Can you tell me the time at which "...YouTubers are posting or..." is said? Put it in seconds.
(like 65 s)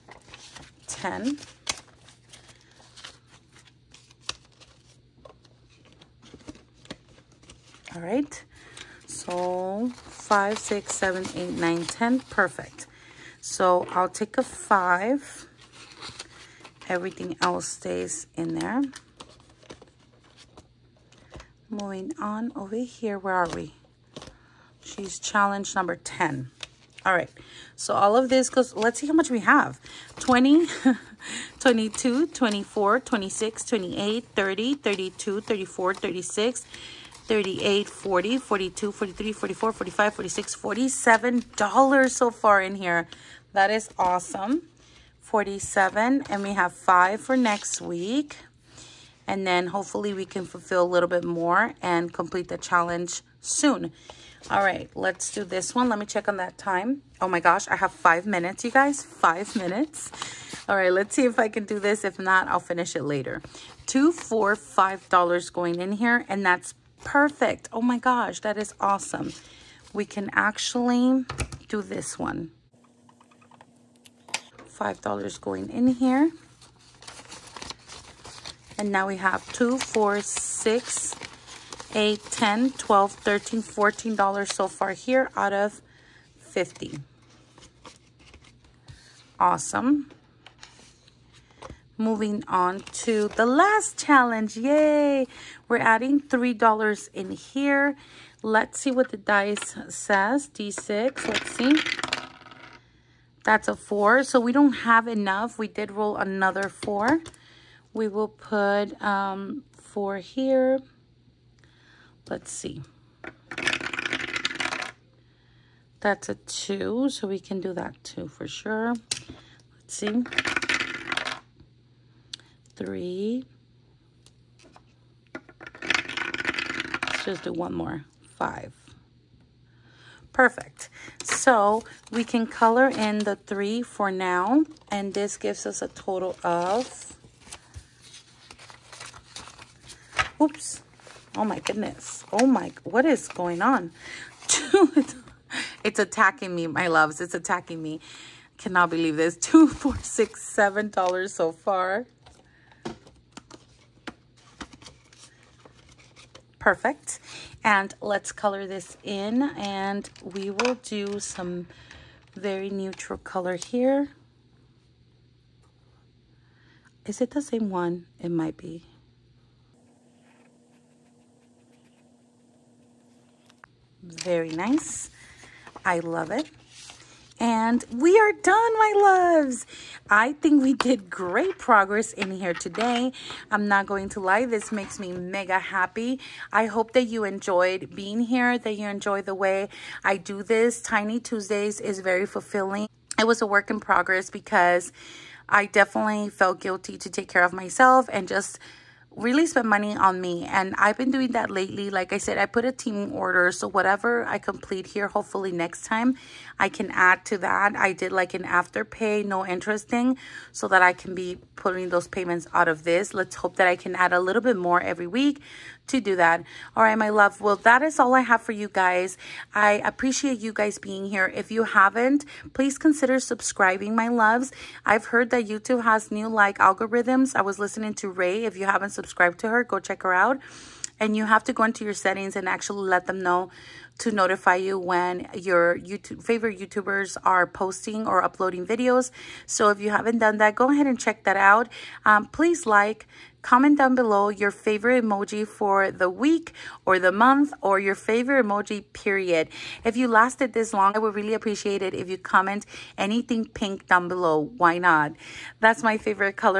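236 s.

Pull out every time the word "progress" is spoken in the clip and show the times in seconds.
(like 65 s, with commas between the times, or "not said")
181 s, 193 s.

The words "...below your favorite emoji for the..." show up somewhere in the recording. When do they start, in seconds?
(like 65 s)
243 s.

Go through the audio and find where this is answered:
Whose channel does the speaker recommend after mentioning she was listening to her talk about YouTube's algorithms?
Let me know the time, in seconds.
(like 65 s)
228 s.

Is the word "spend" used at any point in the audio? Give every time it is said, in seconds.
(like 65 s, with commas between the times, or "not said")
199 s.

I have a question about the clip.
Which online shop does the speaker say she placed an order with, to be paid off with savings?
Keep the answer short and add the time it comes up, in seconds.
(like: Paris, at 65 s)
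Temu, at 202 s.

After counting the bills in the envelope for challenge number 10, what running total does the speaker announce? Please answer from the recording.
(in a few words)
$47.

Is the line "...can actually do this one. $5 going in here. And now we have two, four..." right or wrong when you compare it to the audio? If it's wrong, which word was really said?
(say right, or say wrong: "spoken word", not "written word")
right.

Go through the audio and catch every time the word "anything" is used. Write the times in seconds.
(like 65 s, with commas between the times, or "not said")
252 s.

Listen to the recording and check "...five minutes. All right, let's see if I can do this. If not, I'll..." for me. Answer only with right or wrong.
right.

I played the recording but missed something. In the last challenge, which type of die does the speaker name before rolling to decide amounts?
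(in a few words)
D6.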